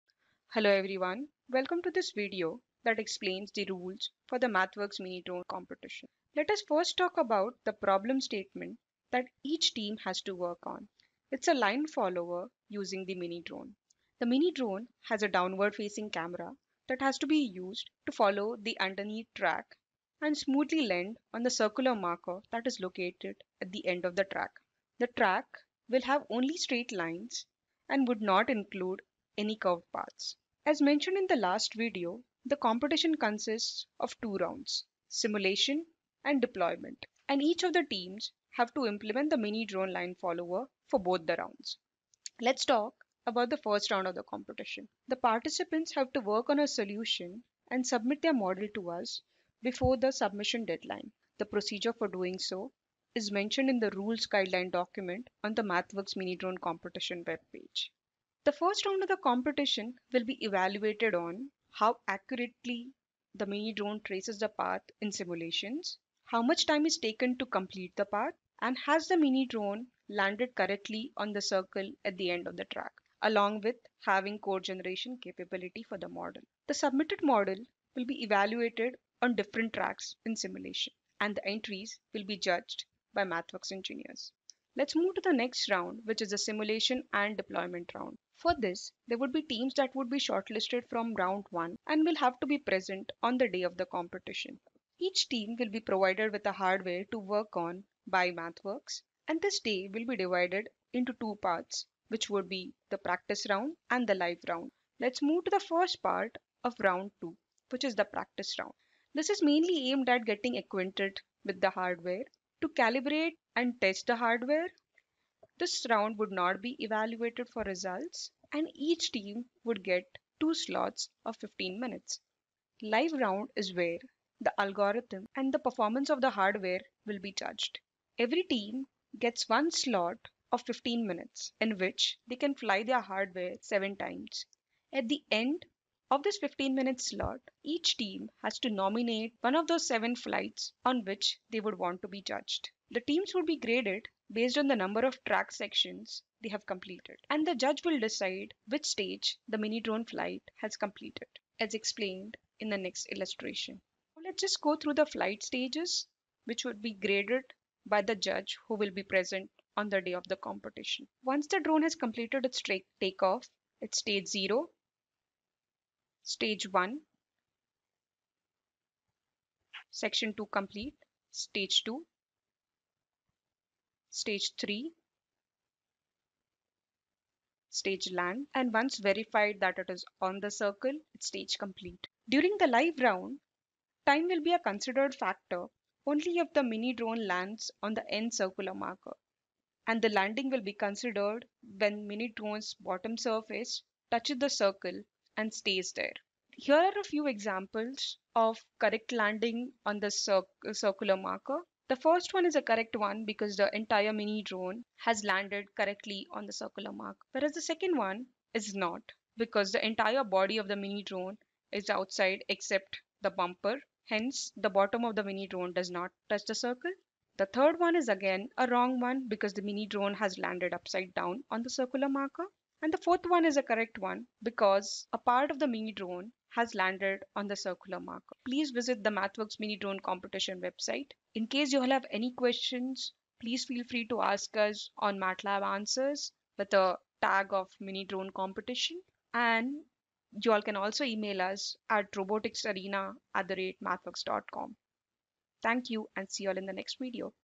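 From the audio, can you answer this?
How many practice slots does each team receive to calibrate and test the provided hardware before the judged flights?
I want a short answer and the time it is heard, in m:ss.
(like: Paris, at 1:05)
2, at 2:00.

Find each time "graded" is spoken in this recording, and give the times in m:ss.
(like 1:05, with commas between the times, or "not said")
2:23, 2:36.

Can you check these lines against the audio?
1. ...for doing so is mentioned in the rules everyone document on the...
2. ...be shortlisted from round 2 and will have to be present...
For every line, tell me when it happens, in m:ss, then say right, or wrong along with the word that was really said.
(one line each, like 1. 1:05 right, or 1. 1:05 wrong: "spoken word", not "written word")
1. 0:51 wrong: "guideline", not "everyone"
2. 1:30 wrong: "1", not "2".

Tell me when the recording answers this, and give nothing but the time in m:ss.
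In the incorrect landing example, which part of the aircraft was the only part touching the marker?
3:33.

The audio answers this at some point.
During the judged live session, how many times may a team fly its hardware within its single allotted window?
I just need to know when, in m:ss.
2:13.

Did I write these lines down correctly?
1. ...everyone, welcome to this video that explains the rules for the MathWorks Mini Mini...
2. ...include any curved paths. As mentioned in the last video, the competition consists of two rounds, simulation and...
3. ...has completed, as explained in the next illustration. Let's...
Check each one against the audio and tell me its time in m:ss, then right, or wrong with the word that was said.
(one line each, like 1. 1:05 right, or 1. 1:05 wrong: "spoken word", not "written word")
1. 0:00 wrong: "Drone", not "Mini"
2. 0:28 right
3. 2:30 right.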